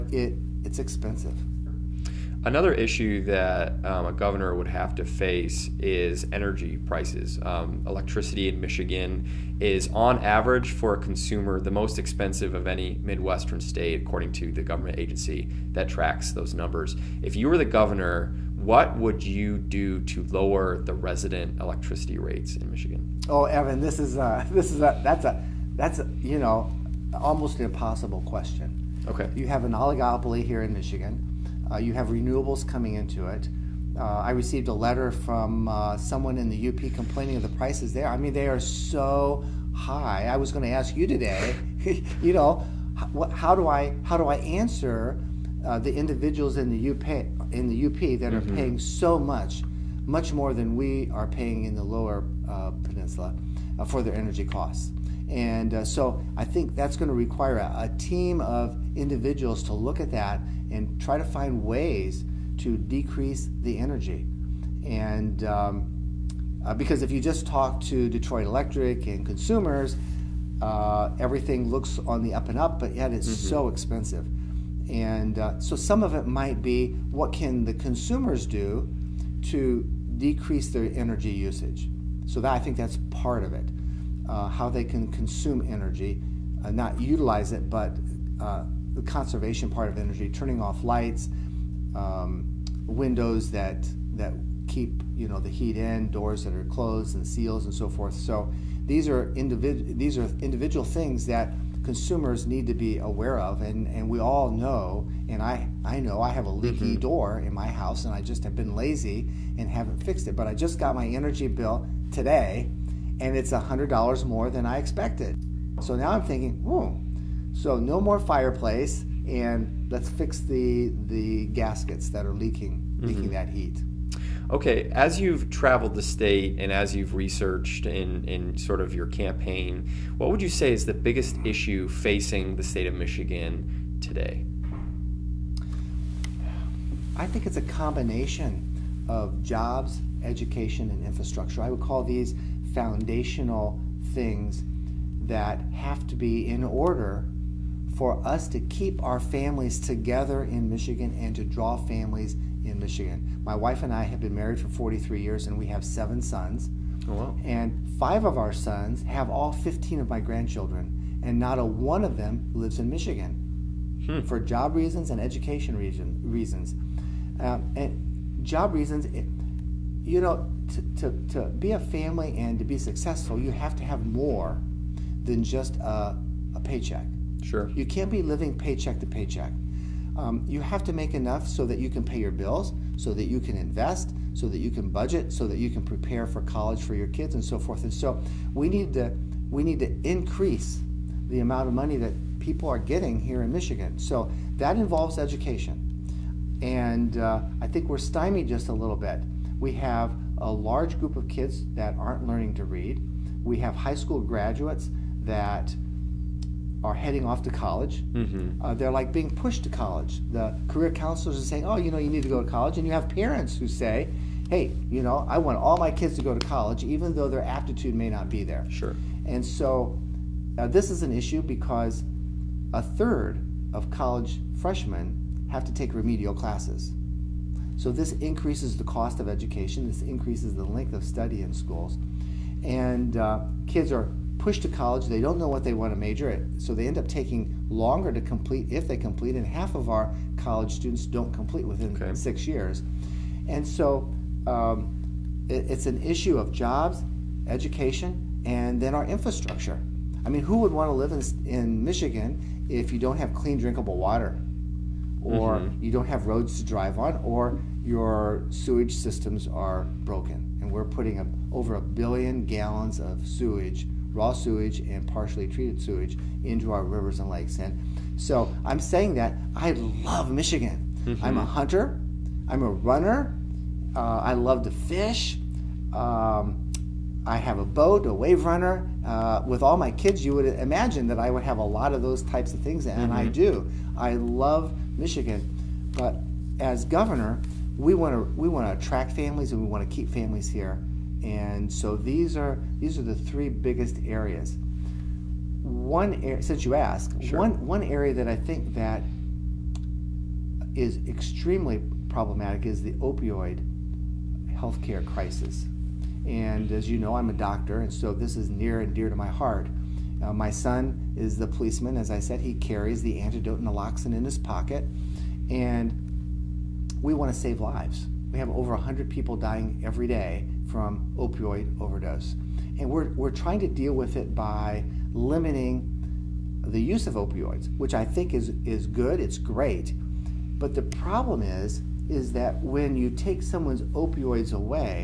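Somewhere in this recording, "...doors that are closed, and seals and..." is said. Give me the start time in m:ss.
1:36.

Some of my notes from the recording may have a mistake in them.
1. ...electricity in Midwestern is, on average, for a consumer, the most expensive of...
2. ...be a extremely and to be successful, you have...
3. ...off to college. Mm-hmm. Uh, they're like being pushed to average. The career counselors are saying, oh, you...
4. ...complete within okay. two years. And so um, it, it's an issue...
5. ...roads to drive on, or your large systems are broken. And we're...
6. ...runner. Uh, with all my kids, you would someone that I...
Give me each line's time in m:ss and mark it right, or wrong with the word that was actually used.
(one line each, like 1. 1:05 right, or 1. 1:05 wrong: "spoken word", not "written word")
1. 0:07 wrong: "Michigan", not "Midwestern"
2. 2:51 wrong: "family", not "extremely"
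3. 3:27 wrong: "college", not "average"
4. 4:01 wrong: "six", not "two"
5. 4:16 wrong: "sewage", not "large"
6. 4:38 wrong: "imagine", not "someone".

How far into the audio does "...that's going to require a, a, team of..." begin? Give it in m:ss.
0:56.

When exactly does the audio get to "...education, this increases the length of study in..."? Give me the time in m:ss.
3:49.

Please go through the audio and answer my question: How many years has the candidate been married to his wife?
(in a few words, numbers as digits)
43.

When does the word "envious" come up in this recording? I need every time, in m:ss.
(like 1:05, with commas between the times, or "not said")
not said.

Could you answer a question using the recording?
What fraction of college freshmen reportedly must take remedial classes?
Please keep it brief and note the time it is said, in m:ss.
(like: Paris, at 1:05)
A third, at 3:42.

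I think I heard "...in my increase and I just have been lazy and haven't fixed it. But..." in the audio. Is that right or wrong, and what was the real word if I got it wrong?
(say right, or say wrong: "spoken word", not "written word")
wrong: "house", not "increase".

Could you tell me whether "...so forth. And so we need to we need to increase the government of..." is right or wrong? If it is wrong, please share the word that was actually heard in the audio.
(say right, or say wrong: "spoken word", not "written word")
wrong: "amount", not "government".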